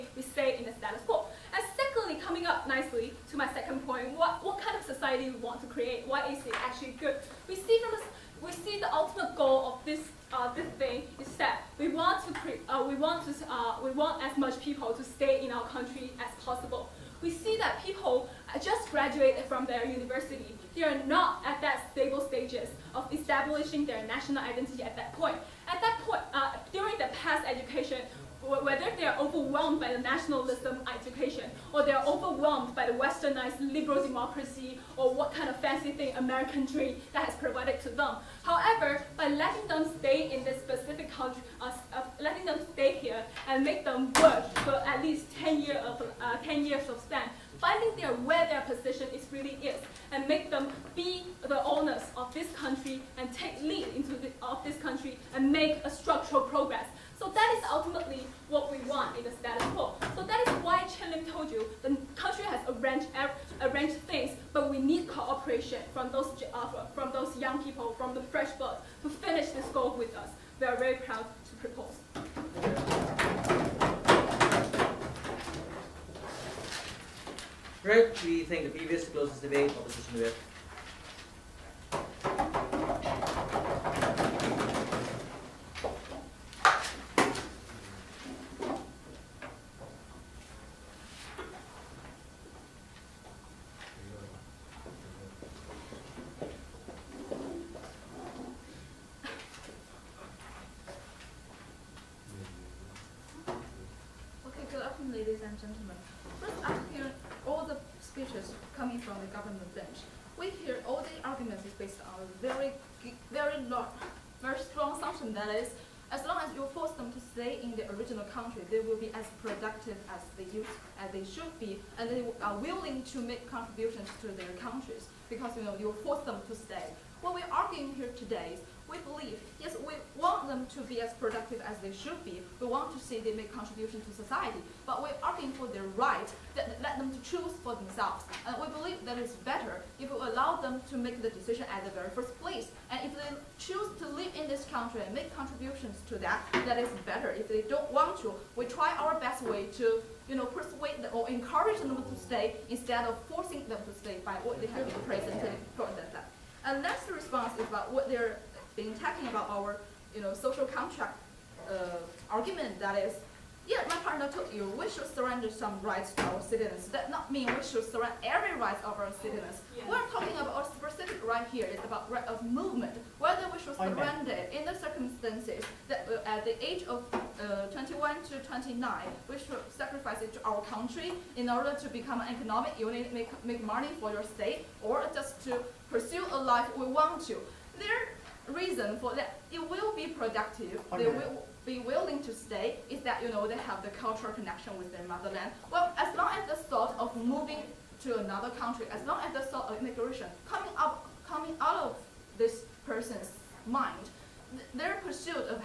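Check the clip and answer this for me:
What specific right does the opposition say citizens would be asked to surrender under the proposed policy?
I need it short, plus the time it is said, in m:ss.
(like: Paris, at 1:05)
right of movement, at 2:52.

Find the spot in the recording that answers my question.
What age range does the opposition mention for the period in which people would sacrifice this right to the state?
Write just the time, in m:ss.
2:57.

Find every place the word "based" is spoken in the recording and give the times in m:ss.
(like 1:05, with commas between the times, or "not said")
1:51.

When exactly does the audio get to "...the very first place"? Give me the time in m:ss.
2:21.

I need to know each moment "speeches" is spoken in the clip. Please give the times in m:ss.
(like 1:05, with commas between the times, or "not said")
1:48.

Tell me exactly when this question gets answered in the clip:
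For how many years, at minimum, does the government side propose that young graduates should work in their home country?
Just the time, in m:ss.
0:46.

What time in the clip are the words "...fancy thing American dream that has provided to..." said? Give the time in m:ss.
0:35.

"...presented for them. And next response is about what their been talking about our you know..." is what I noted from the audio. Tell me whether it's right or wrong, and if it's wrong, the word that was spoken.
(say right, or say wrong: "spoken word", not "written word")
right.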